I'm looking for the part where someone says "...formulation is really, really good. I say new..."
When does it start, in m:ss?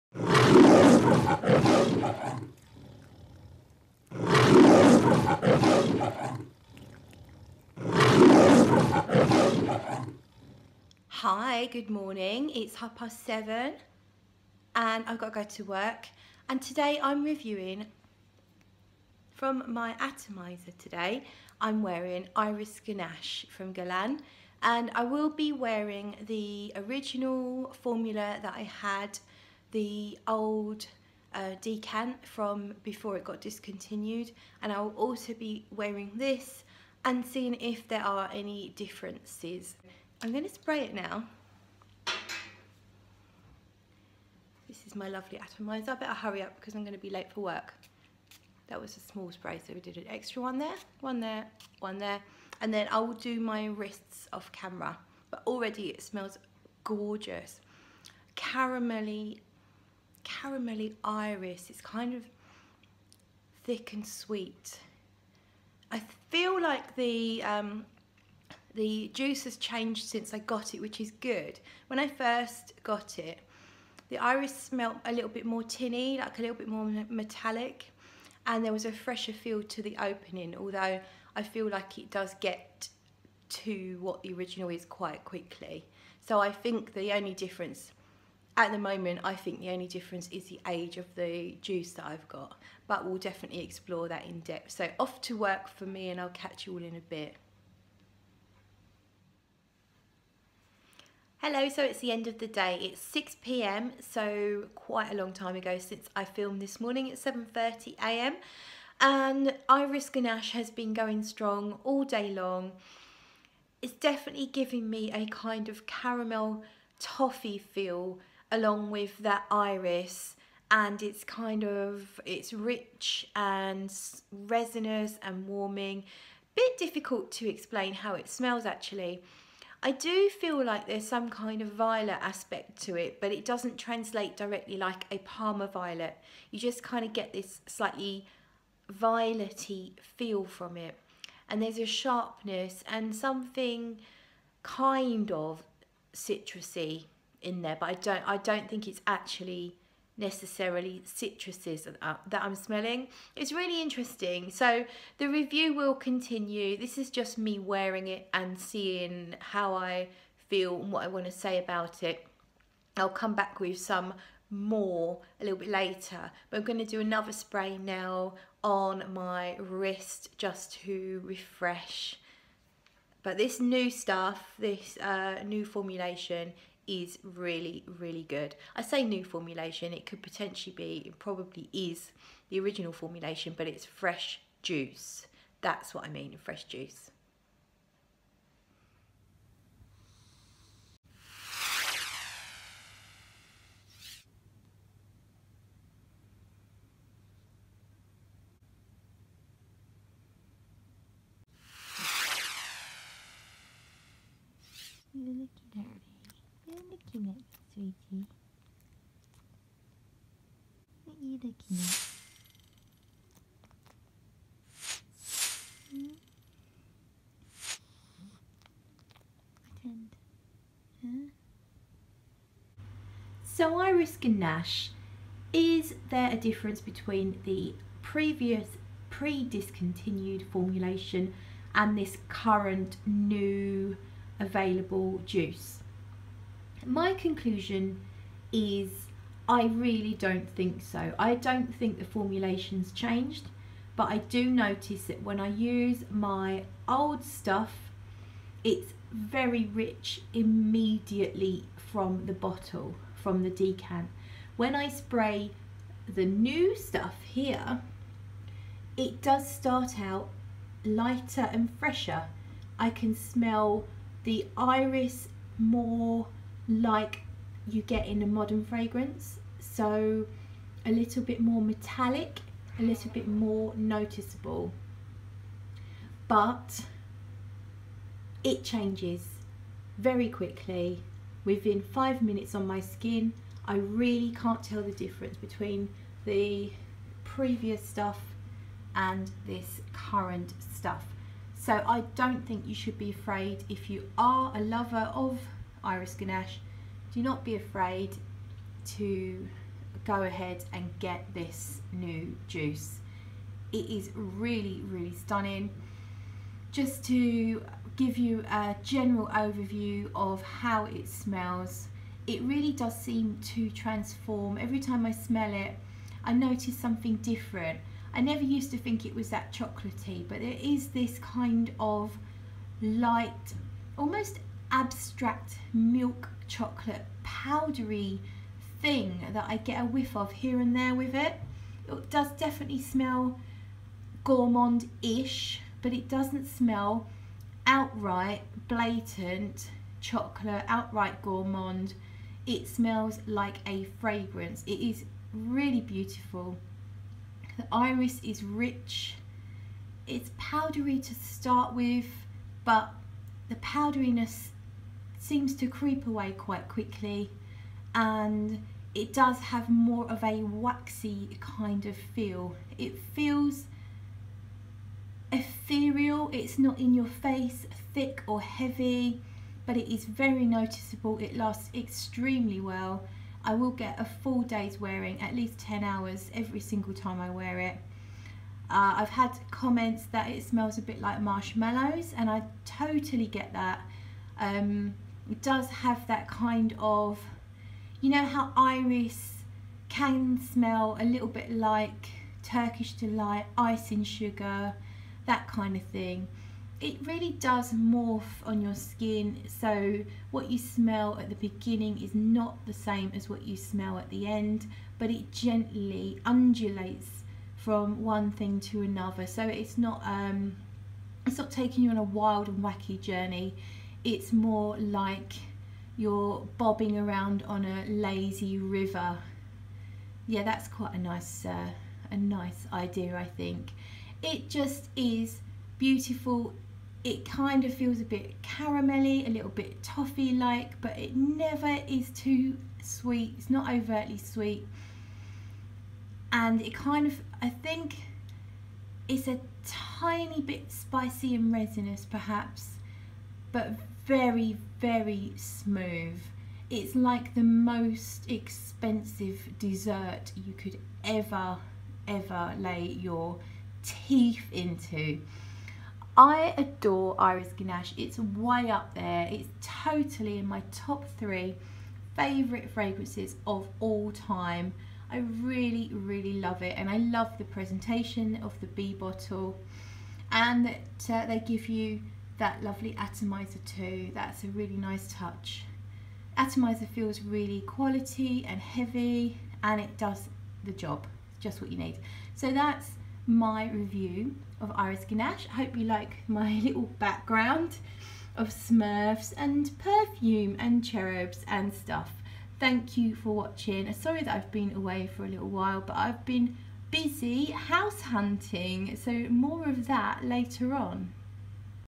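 2:55.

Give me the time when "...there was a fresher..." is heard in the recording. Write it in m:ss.
1:18.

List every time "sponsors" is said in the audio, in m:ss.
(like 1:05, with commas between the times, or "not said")
not said.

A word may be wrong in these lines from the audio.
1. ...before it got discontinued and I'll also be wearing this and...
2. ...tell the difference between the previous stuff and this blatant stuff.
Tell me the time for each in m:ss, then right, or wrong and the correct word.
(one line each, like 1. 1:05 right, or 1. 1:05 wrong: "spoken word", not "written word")
1. 0:32 right
2. 4:44 wrong: "current", not "blatant".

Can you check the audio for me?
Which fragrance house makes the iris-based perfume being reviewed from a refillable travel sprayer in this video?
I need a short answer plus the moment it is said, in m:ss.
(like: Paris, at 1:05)
Guerlain, at 0:23.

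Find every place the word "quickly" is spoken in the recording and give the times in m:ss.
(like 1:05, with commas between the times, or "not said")
1:25, 4:40, 5:56.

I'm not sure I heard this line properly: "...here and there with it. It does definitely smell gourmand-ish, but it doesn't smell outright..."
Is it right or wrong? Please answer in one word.
right.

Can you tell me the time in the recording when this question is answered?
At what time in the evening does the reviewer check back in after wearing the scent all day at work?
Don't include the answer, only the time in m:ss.
1:43.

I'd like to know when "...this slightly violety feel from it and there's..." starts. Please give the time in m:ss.
2:17.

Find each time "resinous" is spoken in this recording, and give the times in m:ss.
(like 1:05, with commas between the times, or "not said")
2:04, 7:21.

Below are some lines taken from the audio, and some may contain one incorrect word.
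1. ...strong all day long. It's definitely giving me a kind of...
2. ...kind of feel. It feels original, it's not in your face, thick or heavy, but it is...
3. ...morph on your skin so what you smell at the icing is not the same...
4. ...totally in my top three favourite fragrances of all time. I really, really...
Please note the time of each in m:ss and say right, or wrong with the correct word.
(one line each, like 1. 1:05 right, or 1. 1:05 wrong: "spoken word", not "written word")
1. 1:51 right
2. 6:01 wrong: "ethereal", not "original"
3. 6:37 wrong: "beginning", not "icing"
4. 7:39 right.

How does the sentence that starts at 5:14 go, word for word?
Every time I smell it, I notice something different.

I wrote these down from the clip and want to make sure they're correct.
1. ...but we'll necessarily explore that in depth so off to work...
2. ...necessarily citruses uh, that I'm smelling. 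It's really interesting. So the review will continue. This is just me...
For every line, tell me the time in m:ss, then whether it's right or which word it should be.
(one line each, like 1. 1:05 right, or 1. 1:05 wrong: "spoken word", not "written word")
1. 1:32 wrong: "definitely", not "necessarily"
2. 2:30 right.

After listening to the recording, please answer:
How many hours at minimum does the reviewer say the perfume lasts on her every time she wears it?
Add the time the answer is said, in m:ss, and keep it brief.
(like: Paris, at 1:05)
10, at 6:15.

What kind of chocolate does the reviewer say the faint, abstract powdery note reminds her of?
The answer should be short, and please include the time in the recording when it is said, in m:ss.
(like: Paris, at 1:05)
Milk chocolate, at 5:25.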